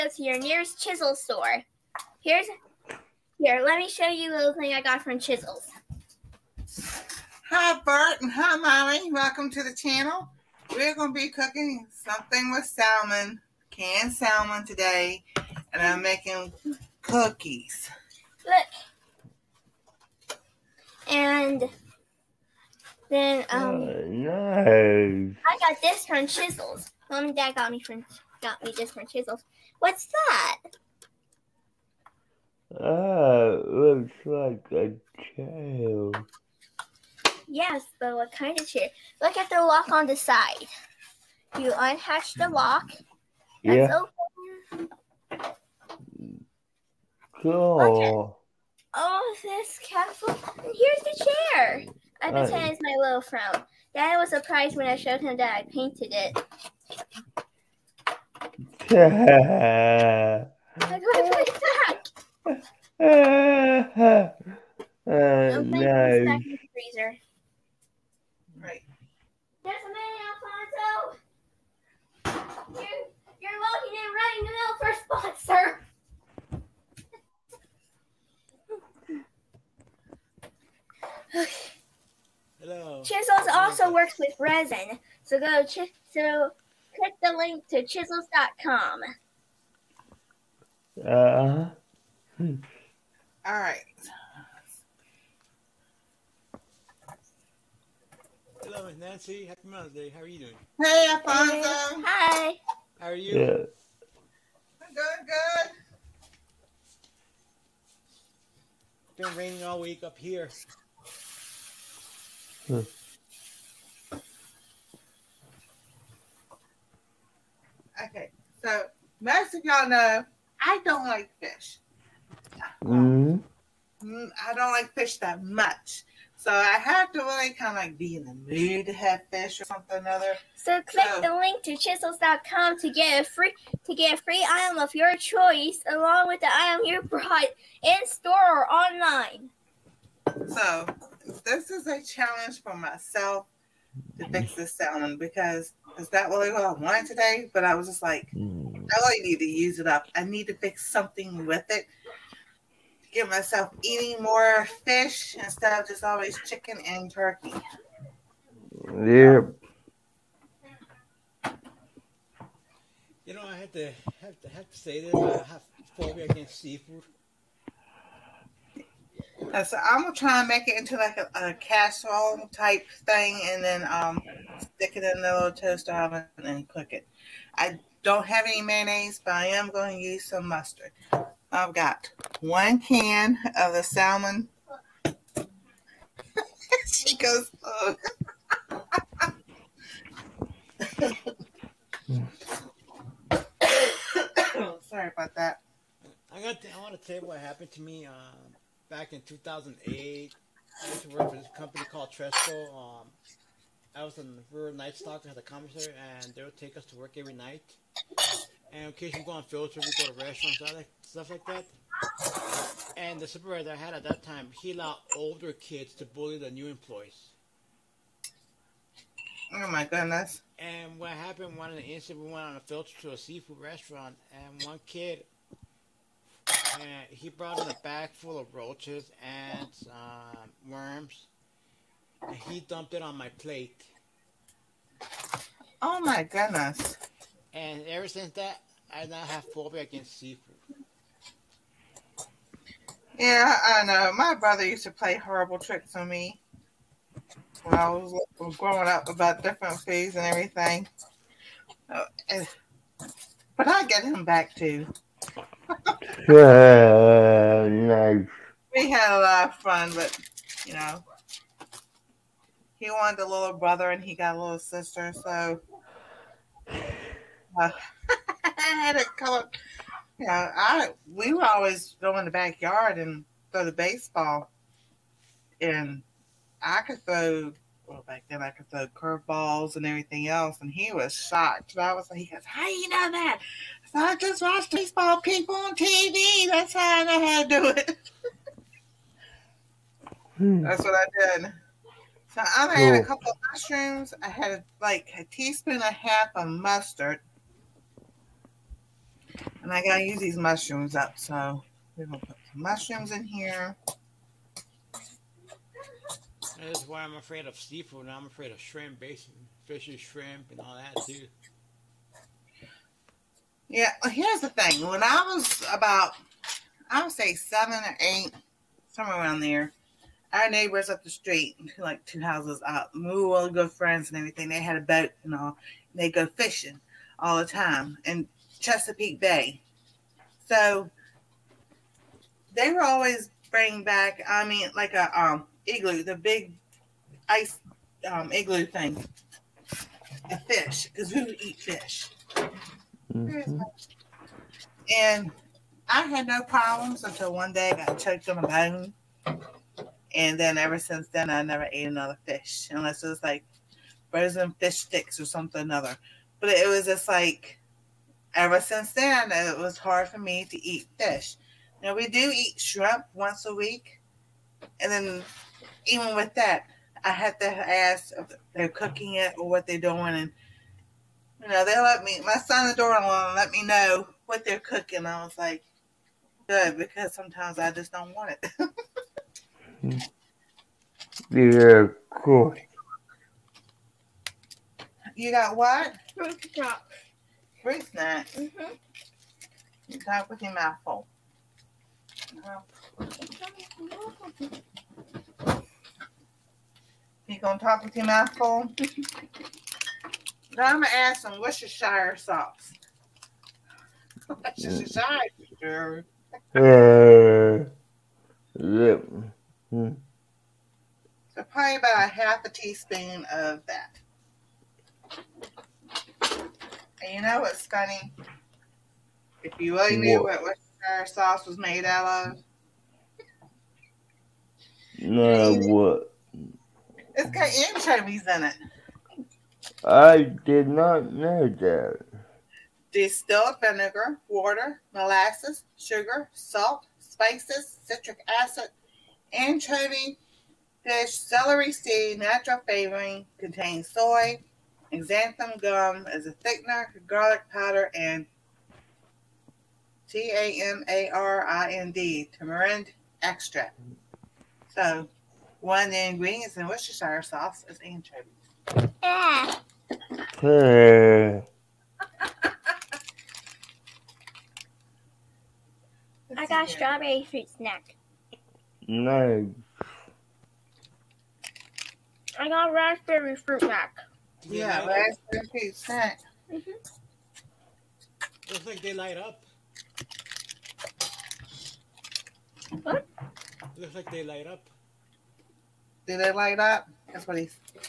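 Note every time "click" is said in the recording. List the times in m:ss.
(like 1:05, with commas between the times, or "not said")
1:26, 2:10.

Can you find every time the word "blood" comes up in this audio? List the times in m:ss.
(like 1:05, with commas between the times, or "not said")
not said.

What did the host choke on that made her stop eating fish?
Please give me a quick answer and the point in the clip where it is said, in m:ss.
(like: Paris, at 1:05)
A bone, at 5:48.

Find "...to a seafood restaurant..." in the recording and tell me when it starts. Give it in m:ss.
3:43.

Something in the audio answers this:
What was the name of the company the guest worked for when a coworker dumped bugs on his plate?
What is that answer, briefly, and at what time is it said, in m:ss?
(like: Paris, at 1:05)
Tresco, at 3:22.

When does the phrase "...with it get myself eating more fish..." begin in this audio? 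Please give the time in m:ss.
2:31.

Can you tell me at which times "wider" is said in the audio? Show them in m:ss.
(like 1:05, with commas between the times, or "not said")
not said.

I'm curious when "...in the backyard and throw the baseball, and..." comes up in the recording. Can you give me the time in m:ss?
4:32.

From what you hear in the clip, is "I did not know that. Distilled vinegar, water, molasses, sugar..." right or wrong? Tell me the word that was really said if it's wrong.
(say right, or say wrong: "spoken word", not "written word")
right.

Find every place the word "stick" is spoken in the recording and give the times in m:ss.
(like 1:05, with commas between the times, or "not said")
2:54, 5:54.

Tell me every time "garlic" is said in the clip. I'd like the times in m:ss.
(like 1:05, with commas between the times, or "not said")
7:27.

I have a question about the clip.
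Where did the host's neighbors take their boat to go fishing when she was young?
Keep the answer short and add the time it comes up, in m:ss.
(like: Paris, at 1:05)
Chesapeake Bay, at 5:28.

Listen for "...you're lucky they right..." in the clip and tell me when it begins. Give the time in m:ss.
1:13.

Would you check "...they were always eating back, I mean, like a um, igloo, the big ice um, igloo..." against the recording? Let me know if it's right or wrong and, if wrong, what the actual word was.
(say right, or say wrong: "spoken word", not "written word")
wrong: "bringing", not "eating".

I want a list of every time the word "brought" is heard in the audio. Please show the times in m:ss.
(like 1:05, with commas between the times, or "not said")
2:17, 3:47.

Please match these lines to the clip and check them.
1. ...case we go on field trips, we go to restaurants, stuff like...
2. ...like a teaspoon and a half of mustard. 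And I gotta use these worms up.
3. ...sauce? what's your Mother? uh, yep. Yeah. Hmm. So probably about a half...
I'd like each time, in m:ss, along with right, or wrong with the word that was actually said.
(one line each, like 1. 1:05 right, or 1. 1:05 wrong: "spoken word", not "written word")
1. 3:28 right
2. 4:54 wrong: "mushrooms", not "worms"
3. 6:42 wrong: "Shire", not "Mother".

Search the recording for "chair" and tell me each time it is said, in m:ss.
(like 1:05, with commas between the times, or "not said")
0:38, 0:51.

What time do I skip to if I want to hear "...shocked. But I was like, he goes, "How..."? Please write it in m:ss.
4:41.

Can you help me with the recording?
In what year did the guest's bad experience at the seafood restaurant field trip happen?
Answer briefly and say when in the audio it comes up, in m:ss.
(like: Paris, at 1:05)
2008, at 3:19.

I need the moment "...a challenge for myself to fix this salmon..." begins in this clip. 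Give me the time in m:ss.
2:21.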